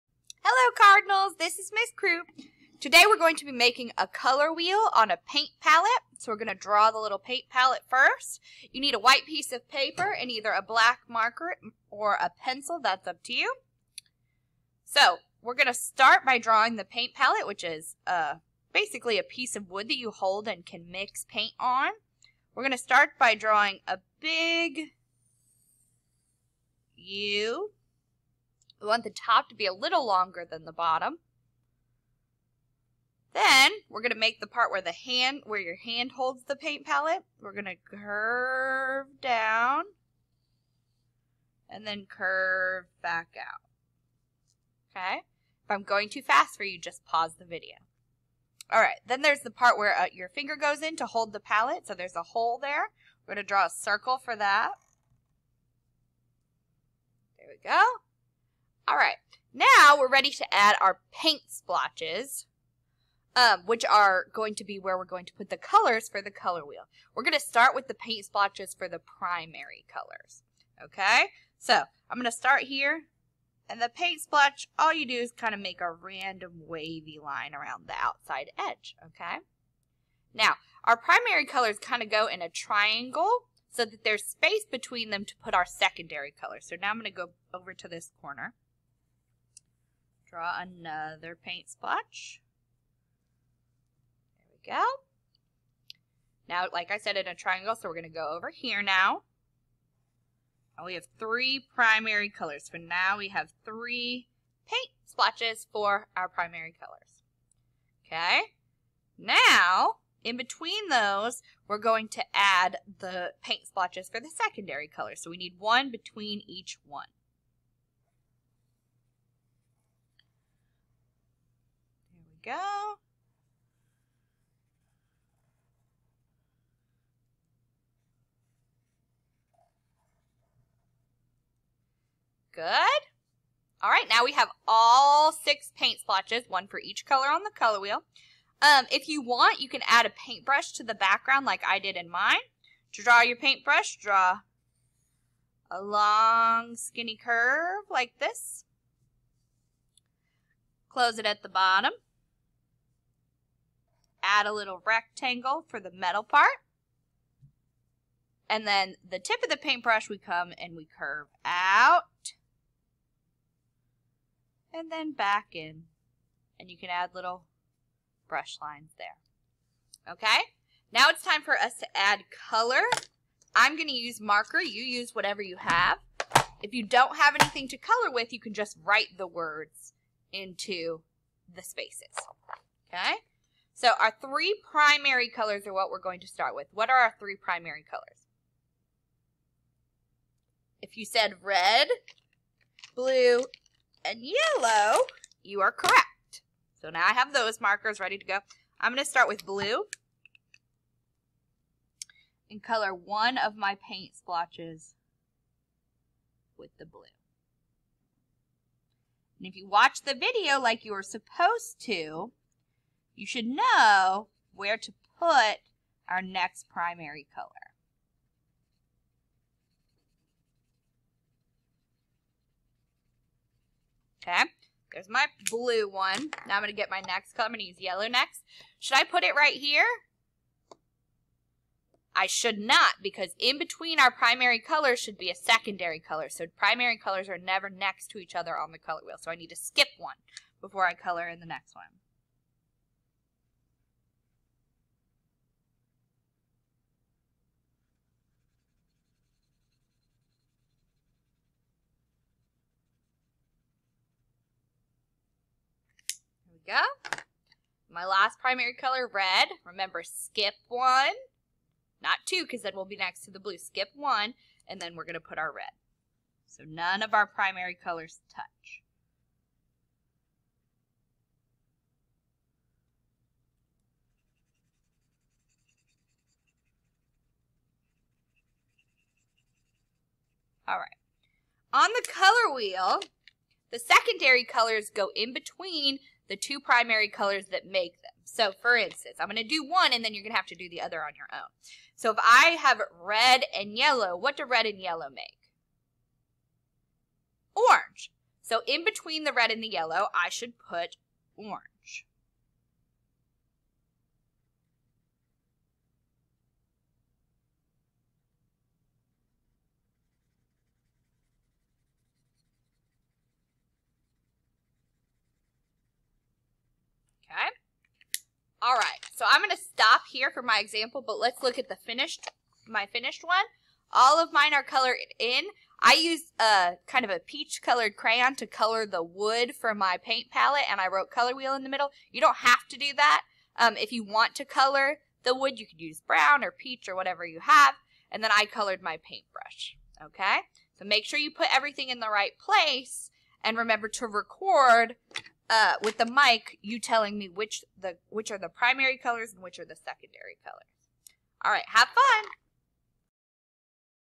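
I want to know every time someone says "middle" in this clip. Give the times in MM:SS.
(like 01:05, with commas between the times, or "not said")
05:31.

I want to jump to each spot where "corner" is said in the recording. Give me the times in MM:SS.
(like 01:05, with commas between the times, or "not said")
01:28.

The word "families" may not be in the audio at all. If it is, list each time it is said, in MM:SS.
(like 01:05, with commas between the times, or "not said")
not said.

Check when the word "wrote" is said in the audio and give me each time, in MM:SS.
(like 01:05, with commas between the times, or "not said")
05:30.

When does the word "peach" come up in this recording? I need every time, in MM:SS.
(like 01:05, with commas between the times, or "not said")
05:27, 05:36.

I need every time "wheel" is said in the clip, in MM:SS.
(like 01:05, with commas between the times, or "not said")
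00:04, 01:06, 02:17, 03:59, 04:42, 05:31.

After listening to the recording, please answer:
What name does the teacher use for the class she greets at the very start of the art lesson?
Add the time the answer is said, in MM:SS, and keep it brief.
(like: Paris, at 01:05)
Cardinals, at 00:00.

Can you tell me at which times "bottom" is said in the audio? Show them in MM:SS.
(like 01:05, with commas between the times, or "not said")
00:30, 02:31.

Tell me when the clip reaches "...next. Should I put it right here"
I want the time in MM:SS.
03:48.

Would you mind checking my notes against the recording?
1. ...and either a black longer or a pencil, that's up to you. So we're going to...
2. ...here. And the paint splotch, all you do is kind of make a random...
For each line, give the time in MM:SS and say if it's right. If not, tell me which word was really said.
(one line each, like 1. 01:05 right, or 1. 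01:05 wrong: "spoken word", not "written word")
1. 00:10 wrong: "marker", not "longer"
2. 01:12 right.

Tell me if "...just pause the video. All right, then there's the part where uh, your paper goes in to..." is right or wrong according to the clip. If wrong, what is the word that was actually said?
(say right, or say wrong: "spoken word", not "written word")
wrong: "finger", not "paper".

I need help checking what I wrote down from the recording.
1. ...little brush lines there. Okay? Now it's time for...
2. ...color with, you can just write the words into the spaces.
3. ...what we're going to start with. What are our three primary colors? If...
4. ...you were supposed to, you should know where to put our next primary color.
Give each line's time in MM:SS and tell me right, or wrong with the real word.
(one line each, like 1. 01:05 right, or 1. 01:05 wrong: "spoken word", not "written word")
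1. 02:47 right
2. 02:57 right
3. 03:05 right
4. 03:30 right.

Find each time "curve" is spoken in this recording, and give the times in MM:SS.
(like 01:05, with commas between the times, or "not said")
00:37, 00:42, 02:27, 02:40.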